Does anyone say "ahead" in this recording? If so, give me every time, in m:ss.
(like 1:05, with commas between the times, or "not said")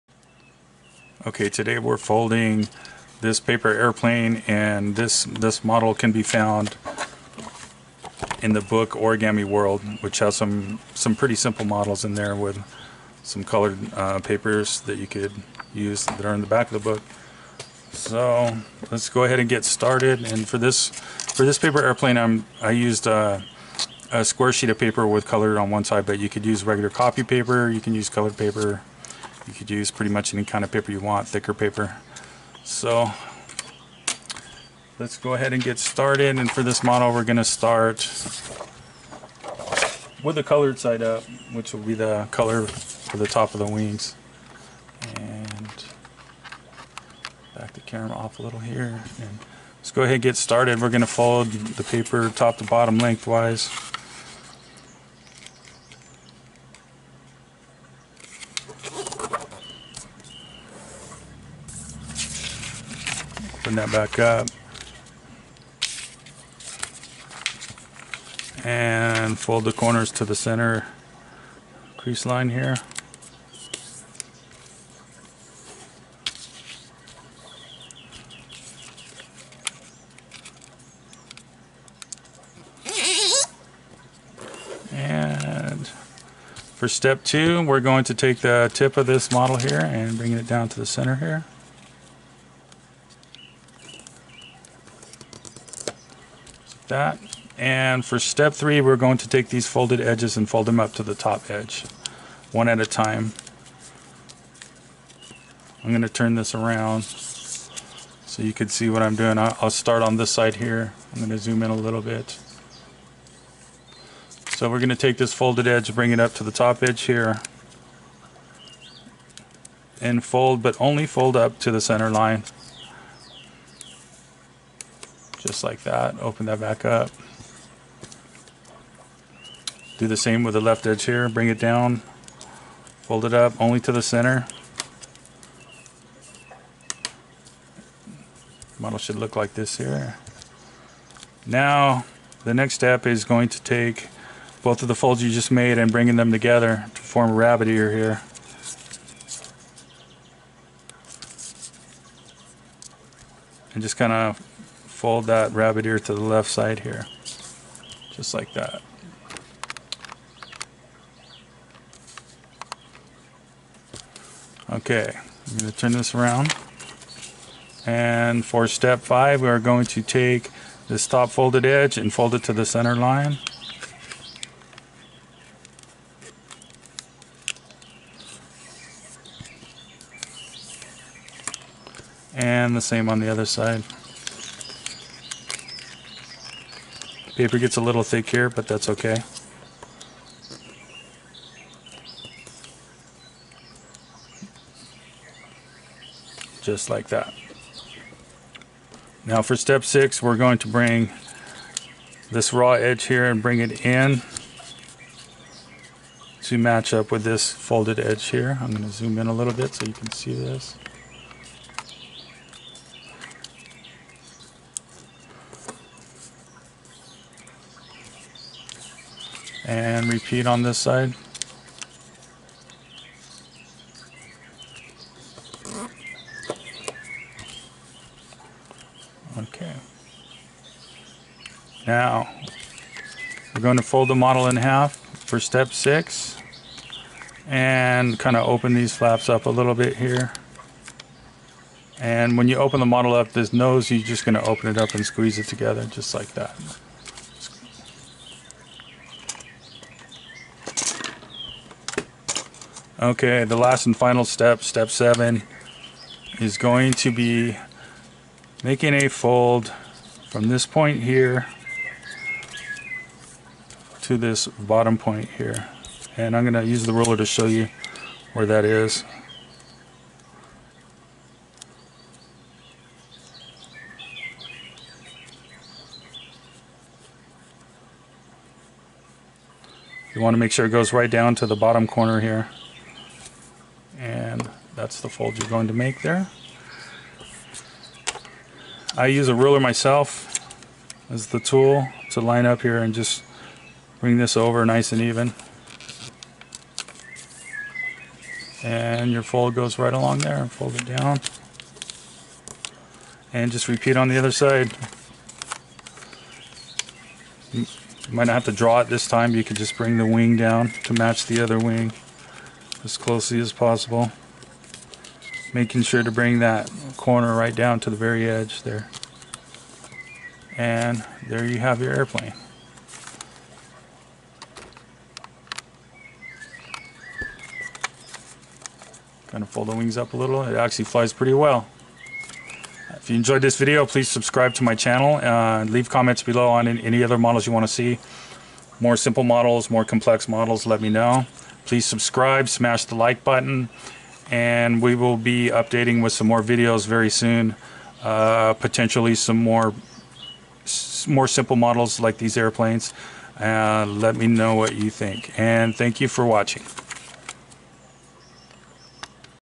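0:19, 0:35, 0:50.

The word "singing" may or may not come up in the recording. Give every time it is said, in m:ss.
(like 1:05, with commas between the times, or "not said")
not said.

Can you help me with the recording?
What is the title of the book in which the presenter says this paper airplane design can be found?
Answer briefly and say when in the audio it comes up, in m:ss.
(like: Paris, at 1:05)
Origami World, at 0:08.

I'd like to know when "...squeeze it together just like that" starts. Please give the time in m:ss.
4:05.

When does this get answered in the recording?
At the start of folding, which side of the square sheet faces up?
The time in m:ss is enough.
0:40.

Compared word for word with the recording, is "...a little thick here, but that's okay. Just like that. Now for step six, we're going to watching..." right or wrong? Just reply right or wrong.
wrong.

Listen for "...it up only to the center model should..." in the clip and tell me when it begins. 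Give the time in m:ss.
2:13.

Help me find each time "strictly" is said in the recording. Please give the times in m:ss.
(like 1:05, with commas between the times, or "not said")
not said.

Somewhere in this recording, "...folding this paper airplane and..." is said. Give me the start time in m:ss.
0:01.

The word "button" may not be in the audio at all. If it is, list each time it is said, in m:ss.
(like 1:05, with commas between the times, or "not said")
5:43.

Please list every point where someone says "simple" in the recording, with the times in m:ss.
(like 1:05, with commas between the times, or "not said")
0:11, 5:38, 5:51.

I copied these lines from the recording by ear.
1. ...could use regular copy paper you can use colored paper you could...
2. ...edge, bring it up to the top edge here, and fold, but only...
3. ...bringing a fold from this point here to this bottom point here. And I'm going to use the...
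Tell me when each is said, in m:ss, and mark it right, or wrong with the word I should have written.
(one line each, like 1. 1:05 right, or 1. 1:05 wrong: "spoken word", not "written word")
1. 0:26 right
2. 1:55 right
3. 4:18 wrong: "making", not "bringing".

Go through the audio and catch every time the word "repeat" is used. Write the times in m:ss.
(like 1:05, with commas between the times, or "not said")
3:40, 5:03.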